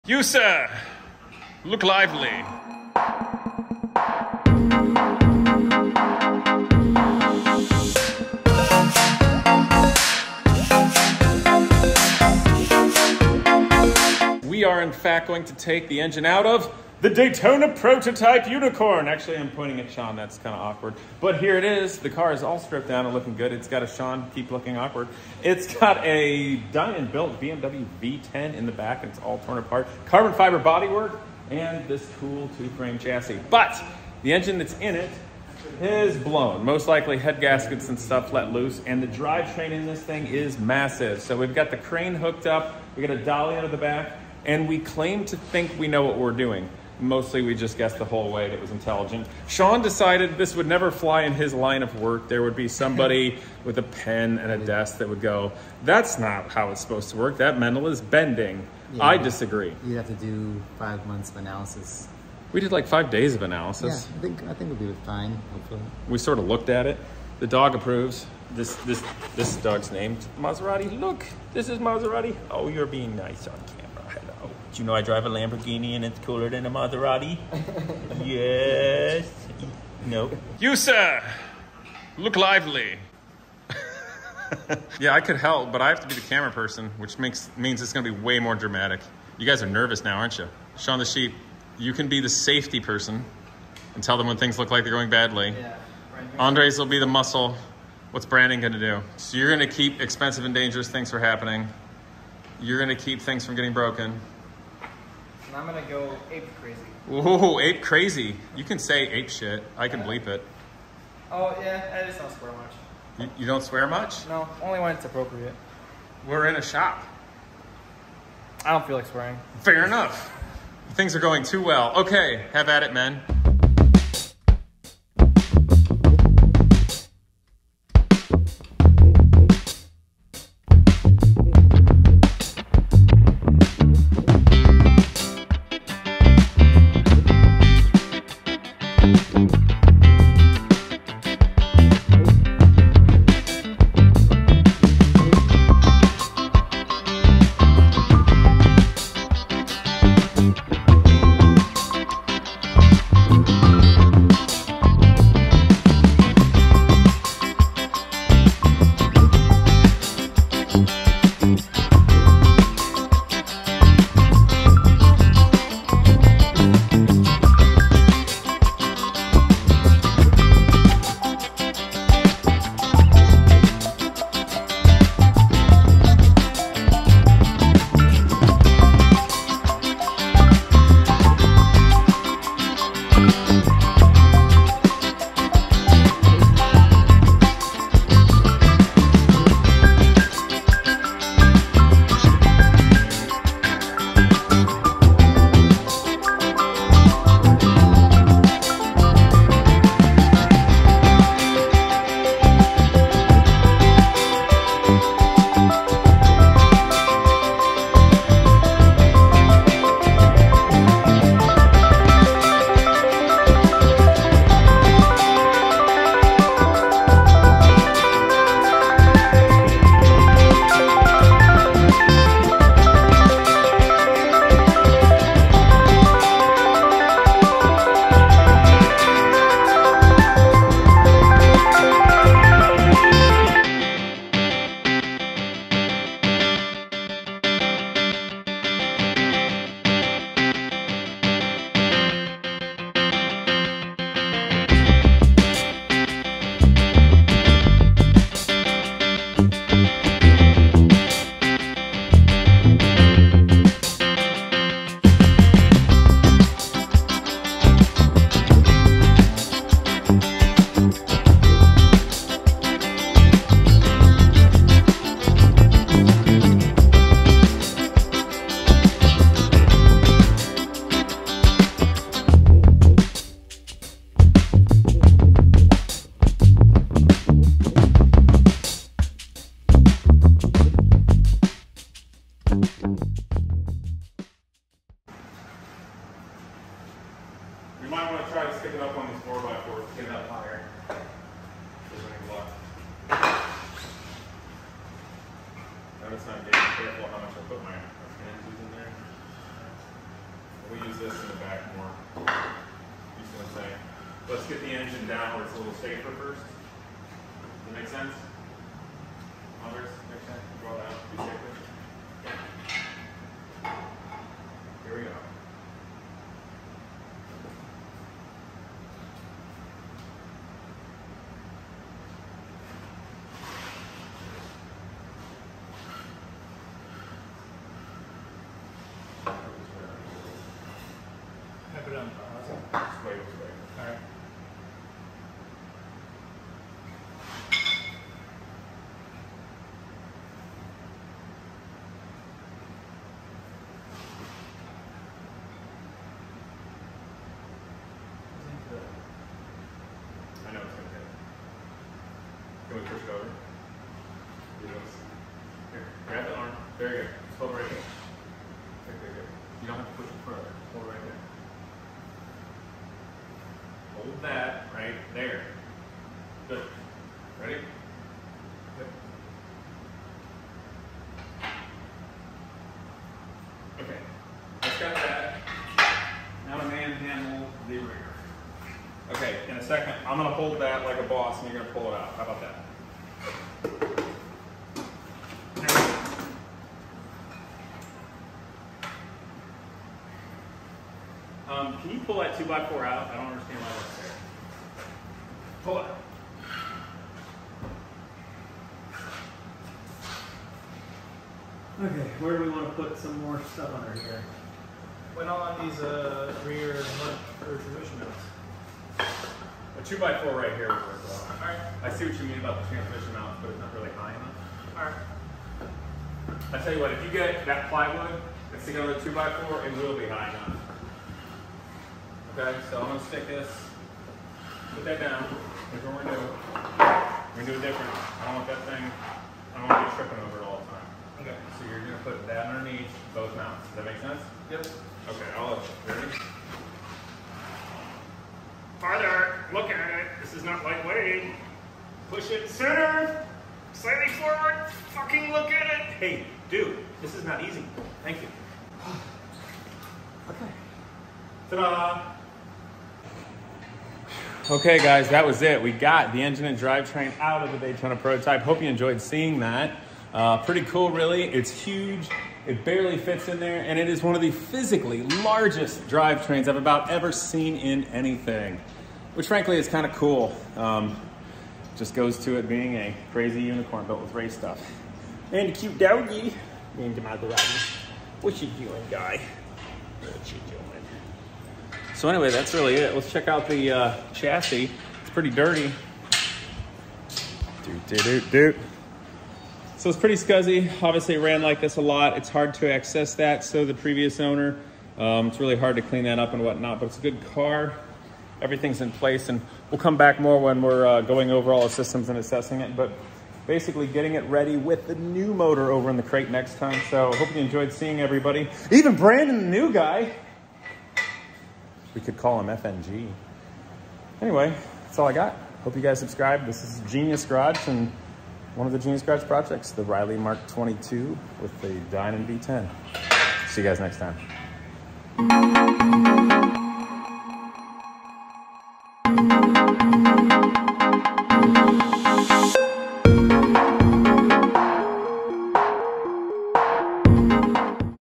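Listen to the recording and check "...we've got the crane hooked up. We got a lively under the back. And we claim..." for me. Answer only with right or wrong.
wrong.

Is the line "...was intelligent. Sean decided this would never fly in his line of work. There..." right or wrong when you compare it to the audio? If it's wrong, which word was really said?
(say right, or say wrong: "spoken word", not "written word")
right.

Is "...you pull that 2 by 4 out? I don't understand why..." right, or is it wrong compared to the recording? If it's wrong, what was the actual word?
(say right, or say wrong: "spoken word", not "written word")
right.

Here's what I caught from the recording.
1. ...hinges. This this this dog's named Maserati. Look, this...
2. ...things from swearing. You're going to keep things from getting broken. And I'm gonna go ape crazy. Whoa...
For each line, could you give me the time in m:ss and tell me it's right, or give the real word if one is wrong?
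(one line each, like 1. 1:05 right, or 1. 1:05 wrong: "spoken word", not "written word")
1. 1:07 wrong: "approves", not "hinges"
2. 1:40 wrong: "happening", not "swearing".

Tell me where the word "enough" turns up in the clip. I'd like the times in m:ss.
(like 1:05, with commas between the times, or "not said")
1:59, 6:54, 7:00.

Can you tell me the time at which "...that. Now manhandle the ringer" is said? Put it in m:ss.
6:14.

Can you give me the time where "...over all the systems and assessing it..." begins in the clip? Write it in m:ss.
8:21.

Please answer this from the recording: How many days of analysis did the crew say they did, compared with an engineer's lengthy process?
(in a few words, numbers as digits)
5.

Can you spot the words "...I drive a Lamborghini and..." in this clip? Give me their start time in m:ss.
1:14.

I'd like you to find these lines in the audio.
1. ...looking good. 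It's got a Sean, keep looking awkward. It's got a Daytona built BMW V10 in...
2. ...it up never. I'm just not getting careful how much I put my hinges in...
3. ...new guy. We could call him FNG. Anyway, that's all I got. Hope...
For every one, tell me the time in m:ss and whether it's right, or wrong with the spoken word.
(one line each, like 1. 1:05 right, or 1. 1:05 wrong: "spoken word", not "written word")
1. 0:23 wrong: "Dinan", not "Daytona"
2. 4:50 wrong: "higher", not "never"
3. 8:29 right.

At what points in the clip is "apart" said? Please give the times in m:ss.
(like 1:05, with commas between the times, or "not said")
0:29.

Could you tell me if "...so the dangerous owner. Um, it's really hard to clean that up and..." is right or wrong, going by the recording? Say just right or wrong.
wrong.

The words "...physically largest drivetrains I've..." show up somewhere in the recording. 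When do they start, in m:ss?
7:44.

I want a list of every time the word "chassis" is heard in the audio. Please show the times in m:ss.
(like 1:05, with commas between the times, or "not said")
0:32, 8:04.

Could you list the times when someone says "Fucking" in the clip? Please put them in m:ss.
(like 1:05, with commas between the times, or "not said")
7:24.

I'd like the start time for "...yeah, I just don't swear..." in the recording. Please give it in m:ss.
1:51.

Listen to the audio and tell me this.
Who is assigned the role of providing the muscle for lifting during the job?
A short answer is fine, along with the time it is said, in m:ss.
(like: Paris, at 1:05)
Andres, at 1:36.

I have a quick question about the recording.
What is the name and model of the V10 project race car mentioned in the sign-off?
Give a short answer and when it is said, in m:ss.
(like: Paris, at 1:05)
Riley Mark 22, at 8:39.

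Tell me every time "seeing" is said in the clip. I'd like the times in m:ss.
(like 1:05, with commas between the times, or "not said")
7:38, 8:27.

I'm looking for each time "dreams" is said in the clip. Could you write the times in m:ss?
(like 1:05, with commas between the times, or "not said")
not said.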